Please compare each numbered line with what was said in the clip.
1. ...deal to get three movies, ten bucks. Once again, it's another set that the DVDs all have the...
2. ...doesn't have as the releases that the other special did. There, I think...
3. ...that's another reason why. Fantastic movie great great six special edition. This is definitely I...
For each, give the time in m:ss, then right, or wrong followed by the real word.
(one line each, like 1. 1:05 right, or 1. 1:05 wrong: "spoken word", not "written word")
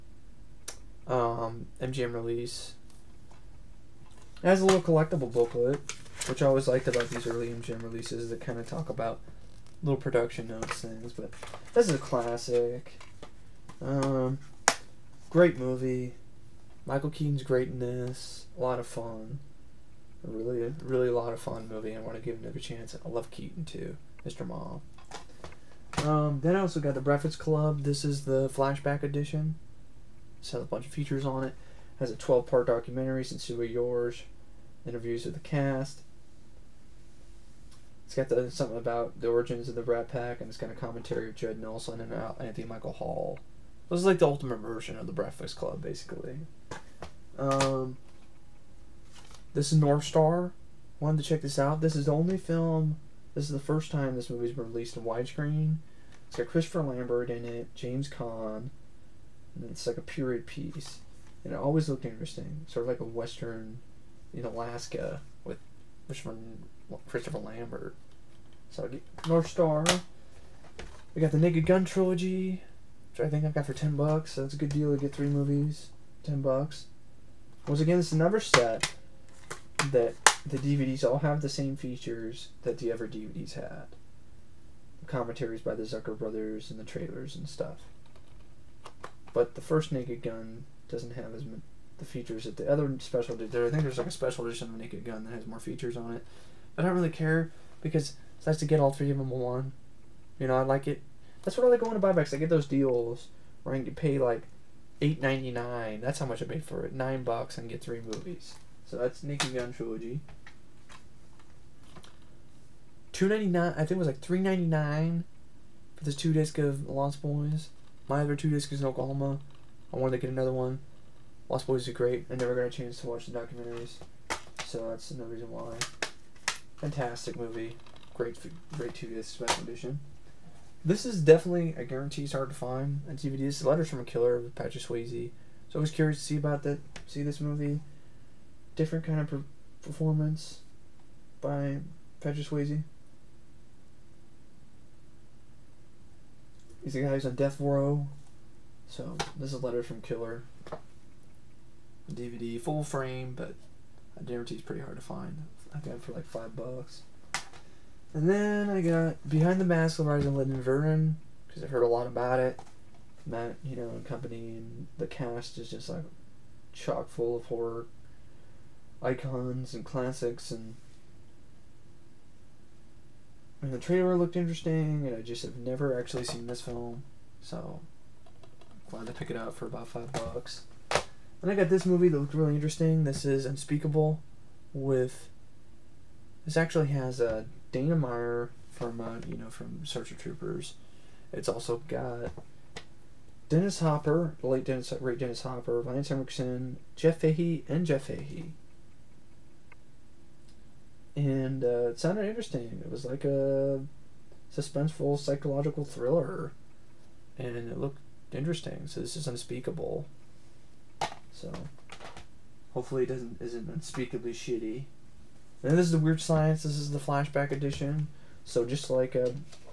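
1. 1:14 right
2. 1:30 wrong: "features", not "releases"
3. 2:04 wrong: "two", not "six".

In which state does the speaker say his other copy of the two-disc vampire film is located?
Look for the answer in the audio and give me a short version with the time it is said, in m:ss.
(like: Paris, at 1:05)
Oklahoma, at 1:58.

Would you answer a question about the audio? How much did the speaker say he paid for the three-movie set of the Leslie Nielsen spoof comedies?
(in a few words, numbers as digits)
$8.99.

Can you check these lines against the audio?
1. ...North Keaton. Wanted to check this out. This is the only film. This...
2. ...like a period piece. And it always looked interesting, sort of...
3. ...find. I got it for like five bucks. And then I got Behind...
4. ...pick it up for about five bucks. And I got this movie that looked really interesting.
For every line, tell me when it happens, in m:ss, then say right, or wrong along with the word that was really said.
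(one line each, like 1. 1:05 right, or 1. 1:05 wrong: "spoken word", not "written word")
1. 0:49 wrong: "Star", not "Keaton"
2. 0:59 right
3. 2:35 right
4. 2:59 right.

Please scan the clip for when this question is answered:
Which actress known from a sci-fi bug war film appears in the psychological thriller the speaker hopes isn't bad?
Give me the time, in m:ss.
3:07.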